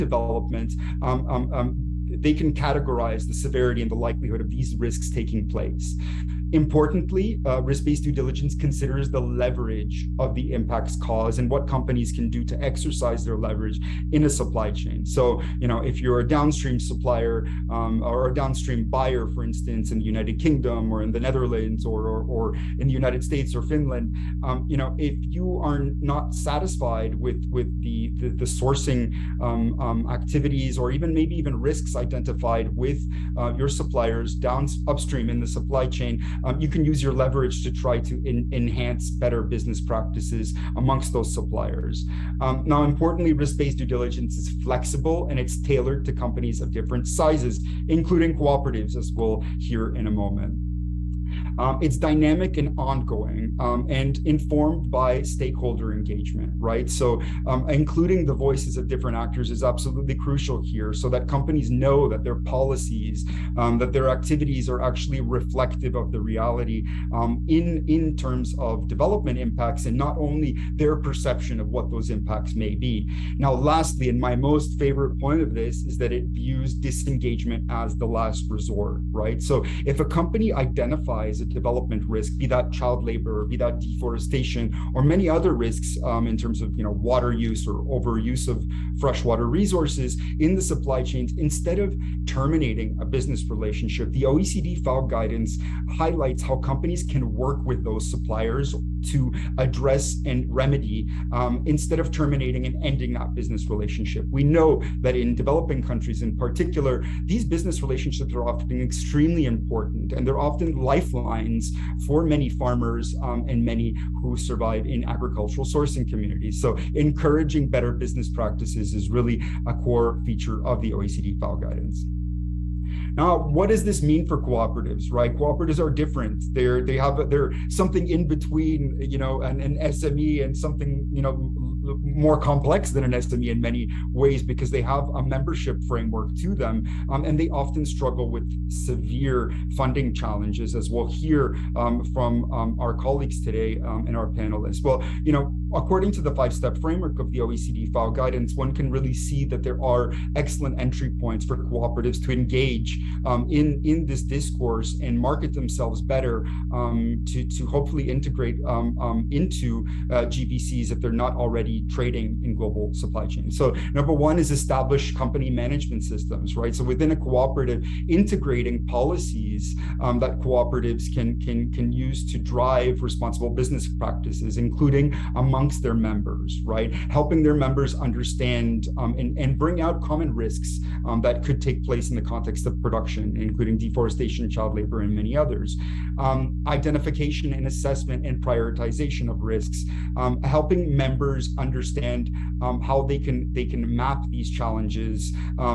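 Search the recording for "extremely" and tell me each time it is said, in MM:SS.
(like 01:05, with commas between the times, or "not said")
01:48.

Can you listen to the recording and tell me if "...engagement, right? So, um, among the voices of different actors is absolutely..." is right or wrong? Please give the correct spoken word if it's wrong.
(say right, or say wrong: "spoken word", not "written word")
wrong: "including", not "among".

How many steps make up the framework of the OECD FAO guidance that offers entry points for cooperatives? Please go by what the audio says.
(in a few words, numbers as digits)
5.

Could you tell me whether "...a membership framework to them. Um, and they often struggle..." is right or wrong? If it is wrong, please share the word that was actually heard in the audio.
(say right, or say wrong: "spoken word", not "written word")
right.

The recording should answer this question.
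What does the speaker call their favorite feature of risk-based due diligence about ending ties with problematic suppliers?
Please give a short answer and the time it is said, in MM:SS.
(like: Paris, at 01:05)
the last resort, at 01:17.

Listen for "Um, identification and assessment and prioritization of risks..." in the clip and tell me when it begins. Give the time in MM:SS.
03:06.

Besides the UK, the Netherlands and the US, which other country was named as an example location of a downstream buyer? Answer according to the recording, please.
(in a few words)
Finland.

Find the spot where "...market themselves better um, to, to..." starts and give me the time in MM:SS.
02:35.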